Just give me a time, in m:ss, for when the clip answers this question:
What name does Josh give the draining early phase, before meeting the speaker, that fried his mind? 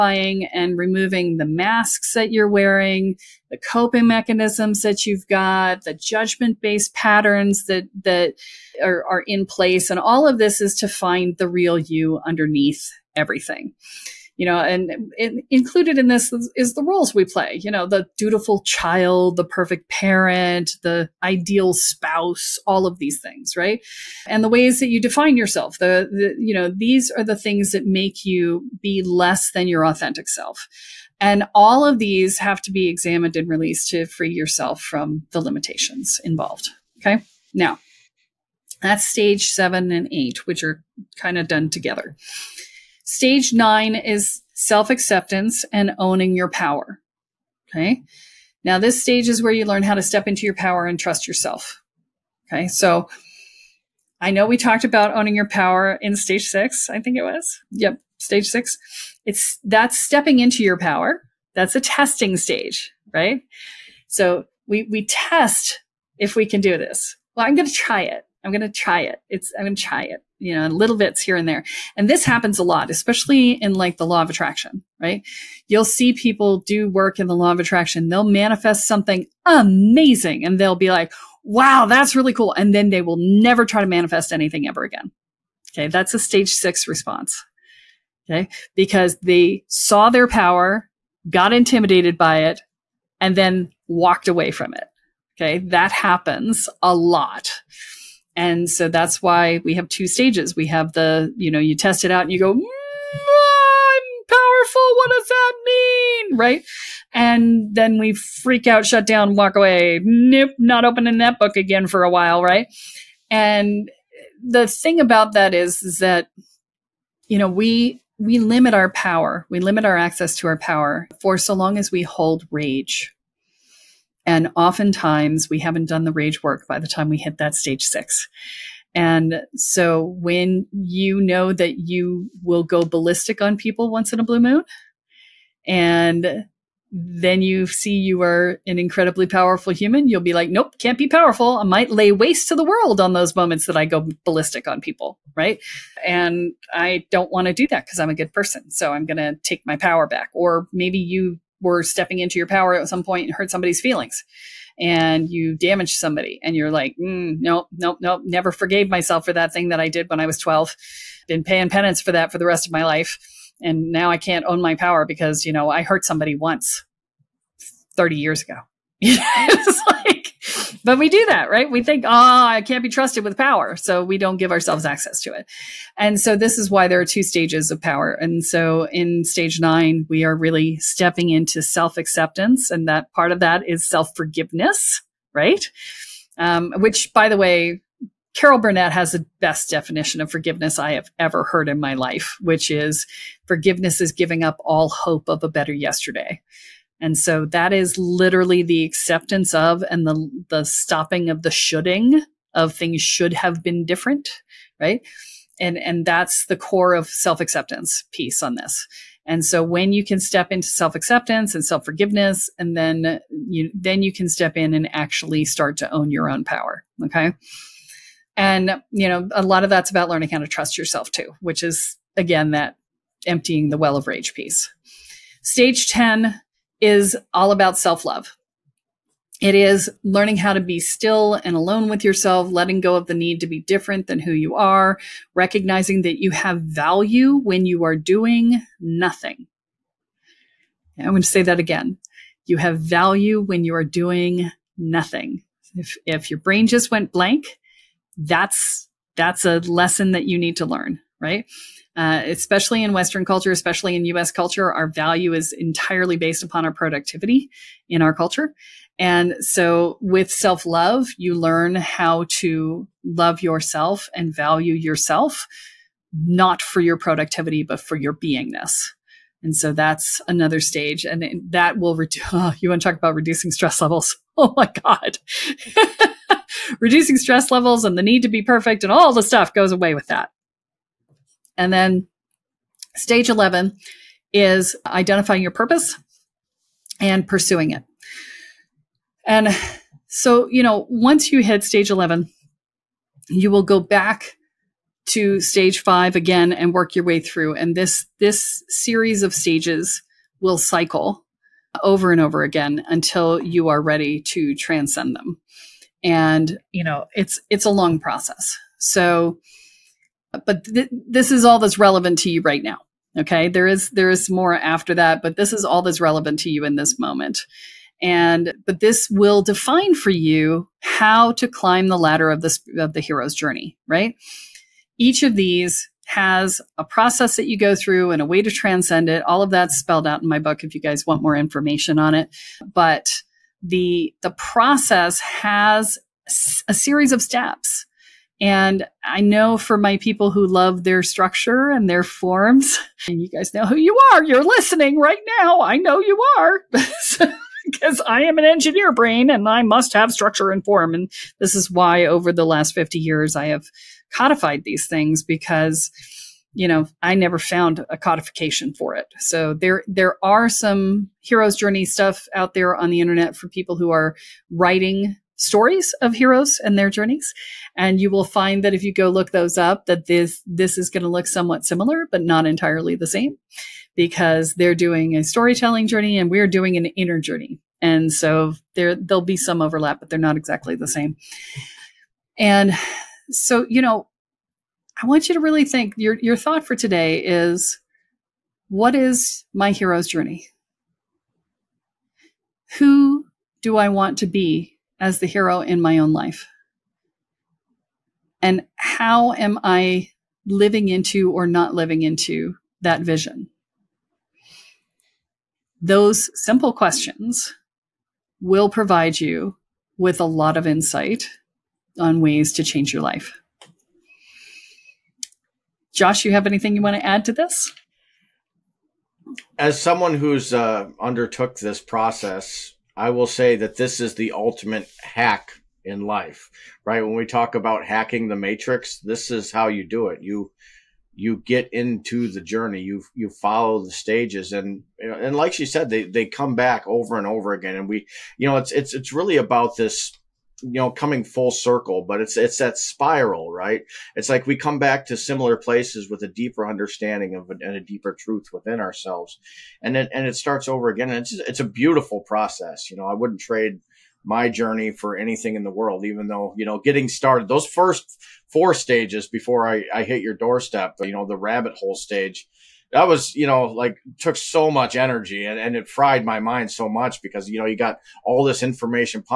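7:41.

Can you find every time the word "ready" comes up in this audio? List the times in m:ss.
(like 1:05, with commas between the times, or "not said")
5:03.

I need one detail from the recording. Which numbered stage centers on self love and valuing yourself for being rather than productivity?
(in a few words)
Stage 10.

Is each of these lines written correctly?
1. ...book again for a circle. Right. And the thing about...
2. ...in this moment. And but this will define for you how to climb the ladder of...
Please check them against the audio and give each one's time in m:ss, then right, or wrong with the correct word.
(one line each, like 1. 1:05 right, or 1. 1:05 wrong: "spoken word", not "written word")
1. 1:51 wrong: "while", not "circle"
2. 5:16 right.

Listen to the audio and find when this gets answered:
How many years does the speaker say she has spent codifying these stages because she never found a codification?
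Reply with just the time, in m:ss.
5:52.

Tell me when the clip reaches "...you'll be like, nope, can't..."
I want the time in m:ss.
2:20.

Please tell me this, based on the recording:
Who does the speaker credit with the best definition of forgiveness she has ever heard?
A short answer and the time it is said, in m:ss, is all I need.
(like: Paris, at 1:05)
Carol Burnett, at 3:08.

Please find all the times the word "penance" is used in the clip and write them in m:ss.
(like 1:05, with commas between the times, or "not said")
2:41.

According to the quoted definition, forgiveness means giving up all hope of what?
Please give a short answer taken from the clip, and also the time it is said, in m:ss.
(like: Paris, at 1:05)
A better yesterday, at 3:15.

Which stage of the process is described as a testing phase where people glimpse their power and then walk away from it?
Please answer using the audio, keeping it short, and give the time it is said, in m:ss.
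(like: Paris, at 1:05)
Stage 6, at 1:25.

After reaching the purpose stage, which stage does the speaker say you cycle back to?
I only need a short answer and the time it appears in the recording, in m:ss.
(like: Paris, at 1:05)
Stage 5, at 4:55.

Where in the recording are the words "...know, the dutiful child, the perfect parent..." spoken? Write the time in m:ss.
0:17.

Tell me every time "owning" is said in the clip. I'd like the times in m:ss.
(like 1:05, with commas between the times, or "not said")
0:45, 0:55.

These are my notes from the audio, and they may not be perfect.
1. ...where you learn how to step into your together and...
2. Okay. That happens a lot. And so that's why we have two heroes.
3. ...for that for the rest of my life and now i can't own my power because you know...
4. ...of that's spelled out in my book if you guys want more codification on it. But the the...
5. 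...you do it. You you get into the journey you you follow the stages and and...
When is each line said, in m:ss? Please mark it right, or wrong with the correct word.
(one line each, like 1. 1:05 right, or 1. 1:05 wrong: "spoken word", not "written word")
1. 0:49 wrong: "power", not "together"
2. 1:35 wrong: "stages", not "heroes"
3. 2:42 right
4. 5:29 wrong: "information", not "codification"
5. 7:09 right.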